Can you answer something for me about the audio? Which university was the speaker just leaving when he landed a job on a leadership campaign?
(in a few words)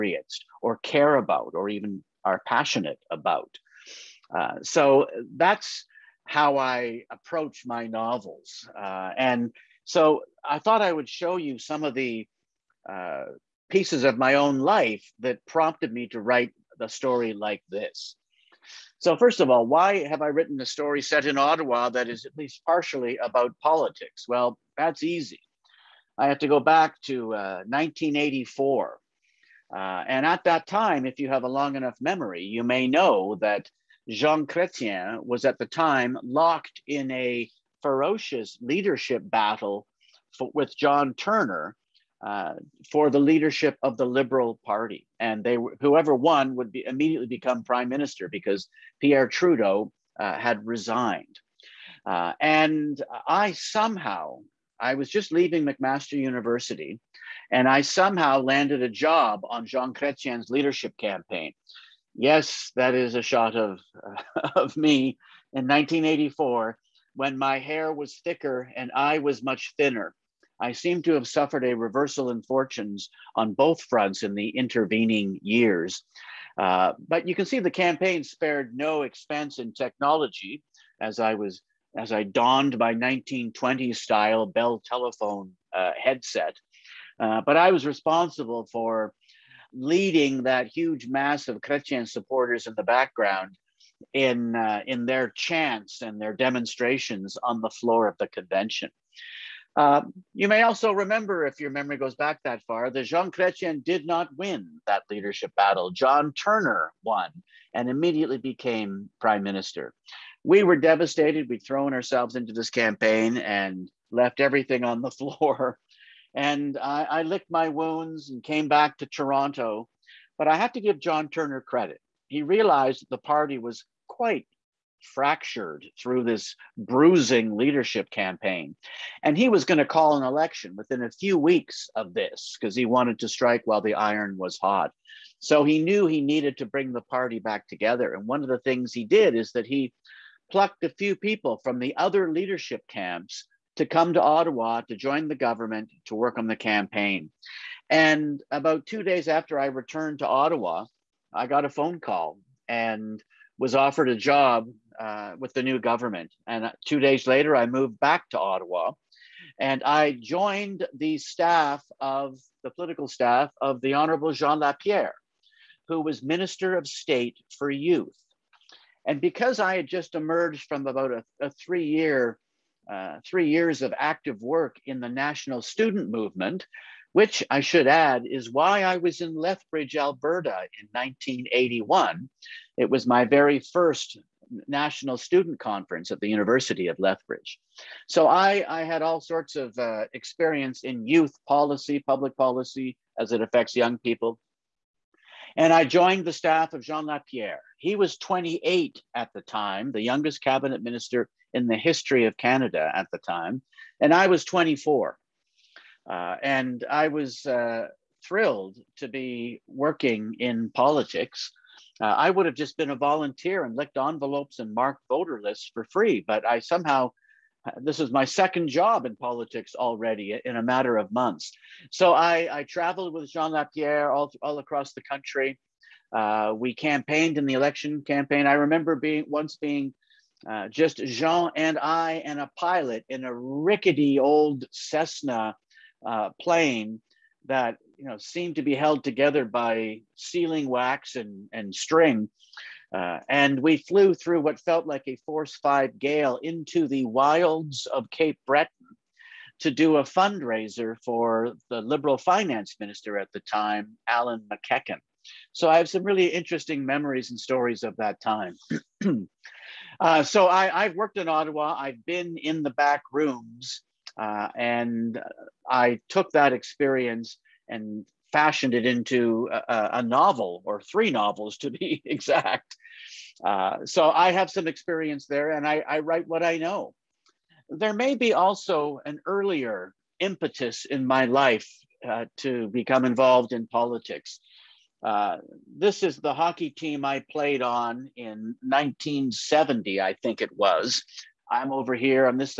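McMaster University.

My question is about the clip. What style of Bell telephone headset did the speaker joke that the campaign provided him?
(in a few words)
1920s style.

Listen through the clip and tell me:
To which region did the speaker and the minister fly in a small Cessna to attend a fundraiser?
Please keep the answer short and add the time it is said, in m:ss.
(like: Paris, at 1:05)
Cape Breton, at 4:08.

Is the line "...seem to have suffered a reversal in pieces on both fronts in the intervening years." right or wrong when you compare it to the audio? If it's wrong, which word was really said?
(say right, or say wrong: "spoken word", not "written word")
wrong: "fortunes", not "pieces".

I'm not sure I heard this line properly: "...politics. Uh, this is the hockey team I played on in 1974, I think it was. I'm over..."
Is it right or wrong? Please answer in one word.
wrong.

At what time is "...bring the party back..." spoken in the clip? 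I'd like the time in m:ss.
2:16.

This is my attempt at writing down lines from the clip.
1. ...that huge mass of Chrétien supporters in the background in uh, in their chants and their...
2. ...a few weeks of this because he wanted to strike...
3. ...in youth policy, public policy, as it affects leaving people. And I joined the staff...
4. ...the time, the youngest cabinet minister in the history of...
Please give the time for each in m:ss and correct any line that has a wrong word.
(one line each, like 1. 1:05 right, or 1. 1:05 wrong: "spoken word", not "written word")
1. 1:30 right
2. 2:11 right
3. 3:10 wrong: "young", not "leaving"
4. 3:19 right.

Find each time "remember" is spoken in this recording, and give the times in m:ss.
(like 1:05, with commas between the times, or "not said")
1:40, 3:48.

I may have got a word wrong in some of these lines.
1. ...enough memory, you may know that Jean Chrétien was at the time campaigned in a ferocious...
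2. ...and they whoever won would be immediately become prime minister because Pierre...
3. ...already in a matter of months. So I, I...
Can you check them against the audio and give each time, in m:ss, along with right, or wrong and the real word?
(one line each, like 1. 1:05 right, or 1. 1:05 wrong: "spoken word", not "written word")
1. 0:31 wrong: "locked", not "campaigned"
2. 0:45 right
3. 3:39 right.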